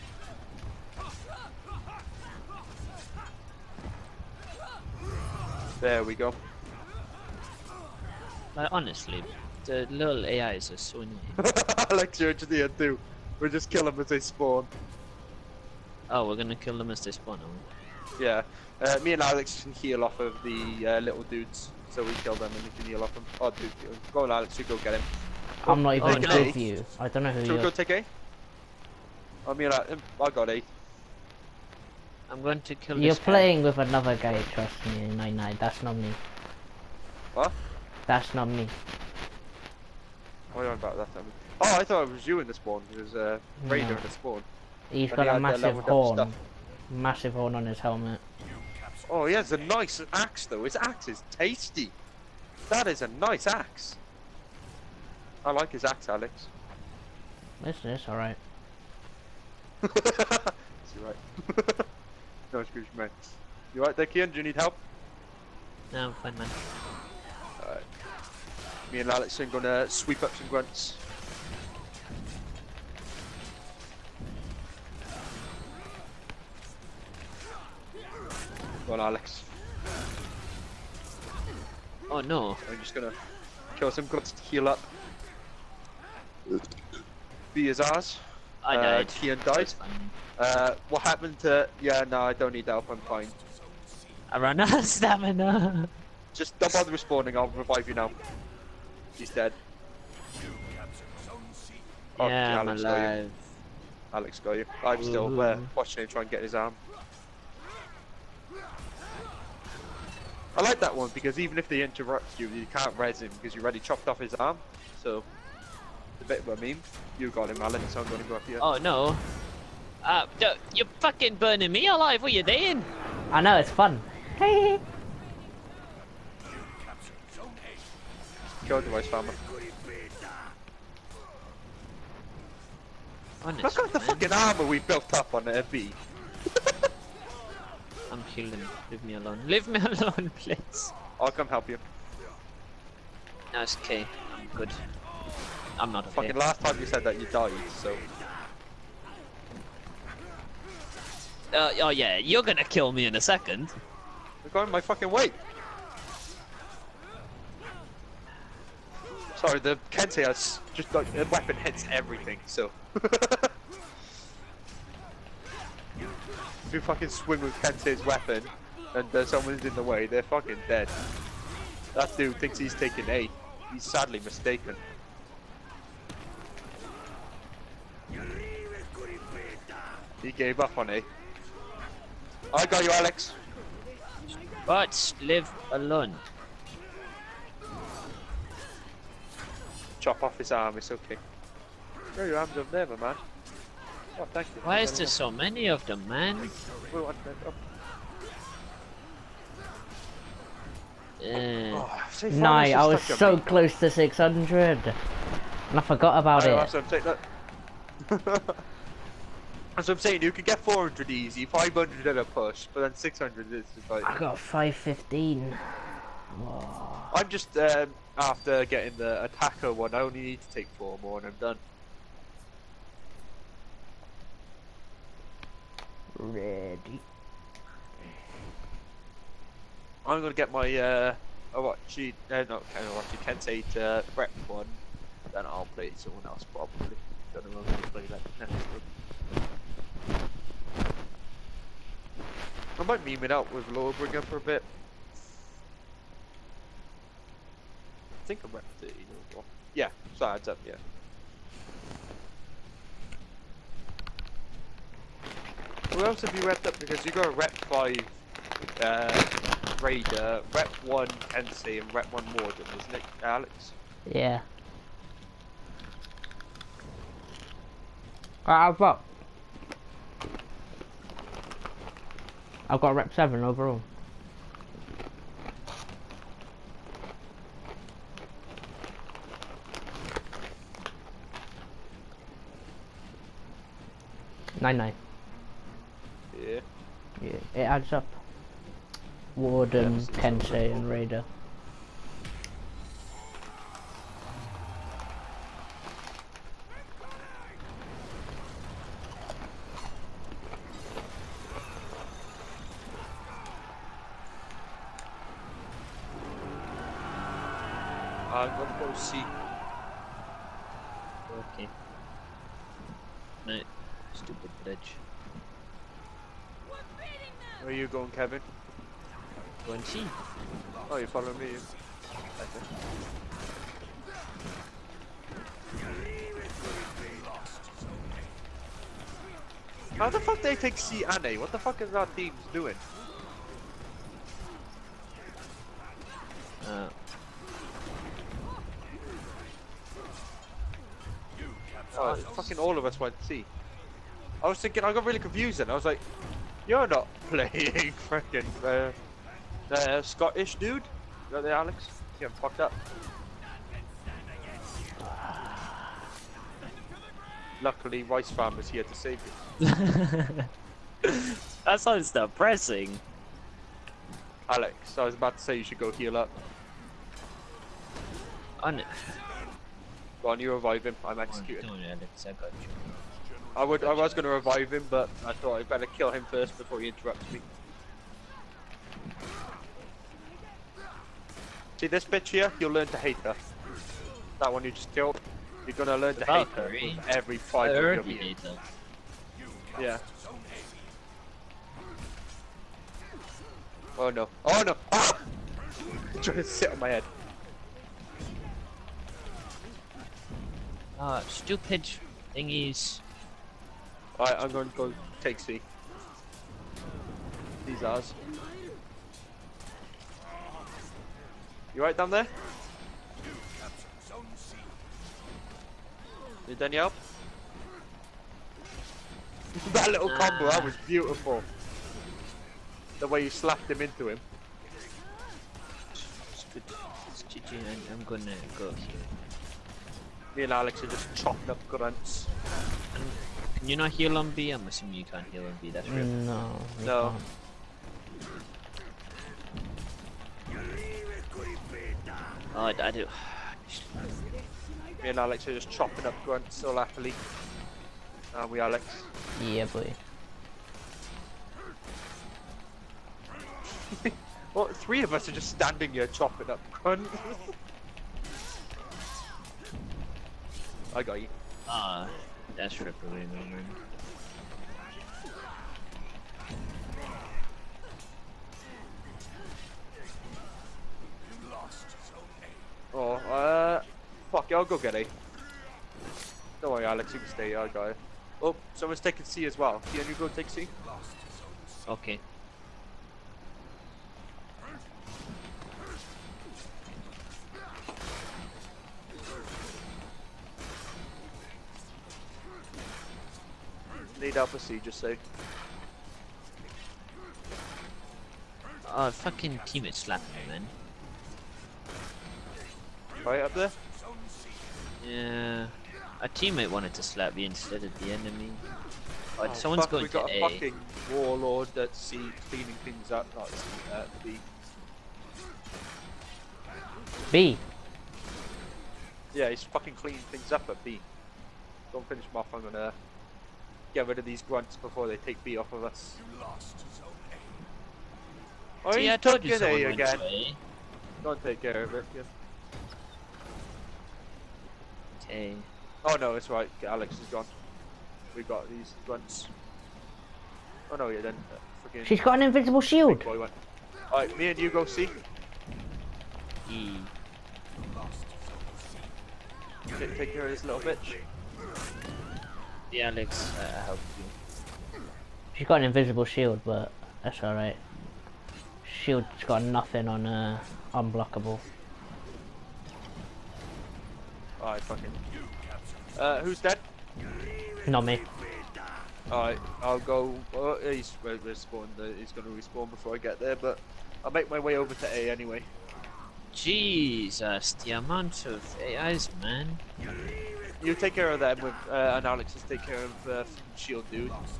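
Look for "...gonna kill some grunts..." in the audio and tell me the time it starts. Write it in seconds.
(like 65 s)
82 s.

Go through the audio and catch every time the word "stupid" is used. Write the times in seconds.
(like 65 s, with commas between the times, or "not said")
401 s.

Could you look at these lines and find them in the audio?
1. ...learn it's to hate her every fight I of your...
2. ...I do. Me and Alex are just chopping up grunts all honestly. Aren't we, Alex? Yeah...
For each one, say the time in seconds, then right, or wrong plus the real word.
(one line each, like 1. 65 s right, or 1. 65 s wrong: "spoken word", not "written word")
1. 385 s right
2. 442 s wrong: "happily", not "honestly".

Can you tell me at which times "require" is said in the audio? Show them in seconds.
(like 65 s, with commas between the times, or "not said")
not said.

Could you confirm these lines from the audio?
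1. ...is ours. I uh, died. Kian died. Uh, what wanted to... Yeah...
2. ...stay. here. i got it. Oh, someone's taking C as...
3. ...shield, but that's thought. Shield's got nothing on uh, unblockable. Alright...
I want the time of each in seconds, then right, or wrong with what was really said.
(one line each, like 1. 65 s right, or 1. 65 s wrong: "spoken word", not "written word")
1. 87 s wrong: "happened", not "wanted"
2. 477 s right
3. 556 s wrong: "alright", not "thought".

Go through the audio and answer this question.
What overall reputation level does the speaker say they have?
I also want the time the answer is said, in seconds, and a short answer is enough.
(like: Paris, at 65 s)
rep 7, at 272 s.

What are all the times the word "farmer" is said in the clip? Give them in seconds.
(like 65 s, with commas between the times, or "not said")
129 s, 358 s.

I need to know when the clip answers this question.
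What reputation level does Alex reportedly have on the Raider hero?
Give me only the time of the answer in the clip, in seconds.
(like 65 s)
257 s.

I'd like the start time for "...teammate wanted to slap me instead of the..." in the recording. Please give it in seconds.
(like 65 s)
506 s.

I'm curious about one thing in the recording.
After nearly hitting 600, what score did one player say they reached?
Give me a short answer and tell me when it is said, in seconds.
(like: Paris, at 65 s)
515, at 214 s.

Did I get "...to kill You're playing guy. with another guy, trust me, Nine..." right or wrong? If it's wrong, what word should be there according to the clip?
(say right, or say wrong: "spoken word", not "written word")
right.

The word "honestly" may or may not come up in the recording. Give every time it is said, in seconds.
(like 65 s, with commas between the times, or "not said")
8 s, 133 s.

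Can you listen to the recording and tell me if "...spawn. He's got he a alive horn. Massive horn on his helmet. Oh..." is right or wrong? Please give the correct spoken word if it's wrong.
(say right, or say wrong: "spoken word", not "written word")
wrong: "massive", not "alive".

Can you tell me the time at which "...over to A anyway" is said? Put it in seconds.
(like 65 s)
574 s.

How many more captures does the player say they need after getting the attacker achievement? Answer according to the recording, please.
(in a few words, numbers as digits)
4.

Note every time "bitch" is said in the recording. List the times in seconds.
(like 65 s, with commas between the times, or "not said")
382 s, 550 s.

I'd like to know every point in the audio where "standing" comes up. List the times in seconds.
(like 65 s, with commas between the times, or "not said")
455 s.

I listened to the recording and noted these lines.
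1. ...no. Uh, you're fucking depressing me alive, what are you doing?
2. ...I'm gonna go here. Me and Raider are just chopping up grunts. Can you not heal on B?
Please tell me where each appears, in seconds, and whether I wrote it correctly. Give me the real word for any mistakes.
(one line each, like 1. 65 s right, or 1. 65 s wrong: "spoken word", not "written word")
1. 118 s wrong: "burning", not "depressing"
2. 427 s wrong: "Alex", not "Raider".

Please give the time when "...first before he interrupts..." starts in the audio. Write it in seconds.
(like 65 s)
376 s.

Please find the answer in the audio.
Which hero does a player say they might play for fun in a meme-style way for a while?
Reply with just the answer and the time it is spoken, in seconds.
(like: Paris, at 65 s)
Lawbringer, at 243 s.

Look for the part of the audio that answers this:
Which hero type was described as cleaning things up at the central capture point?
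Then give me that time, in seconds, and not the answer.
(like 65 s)
511 s.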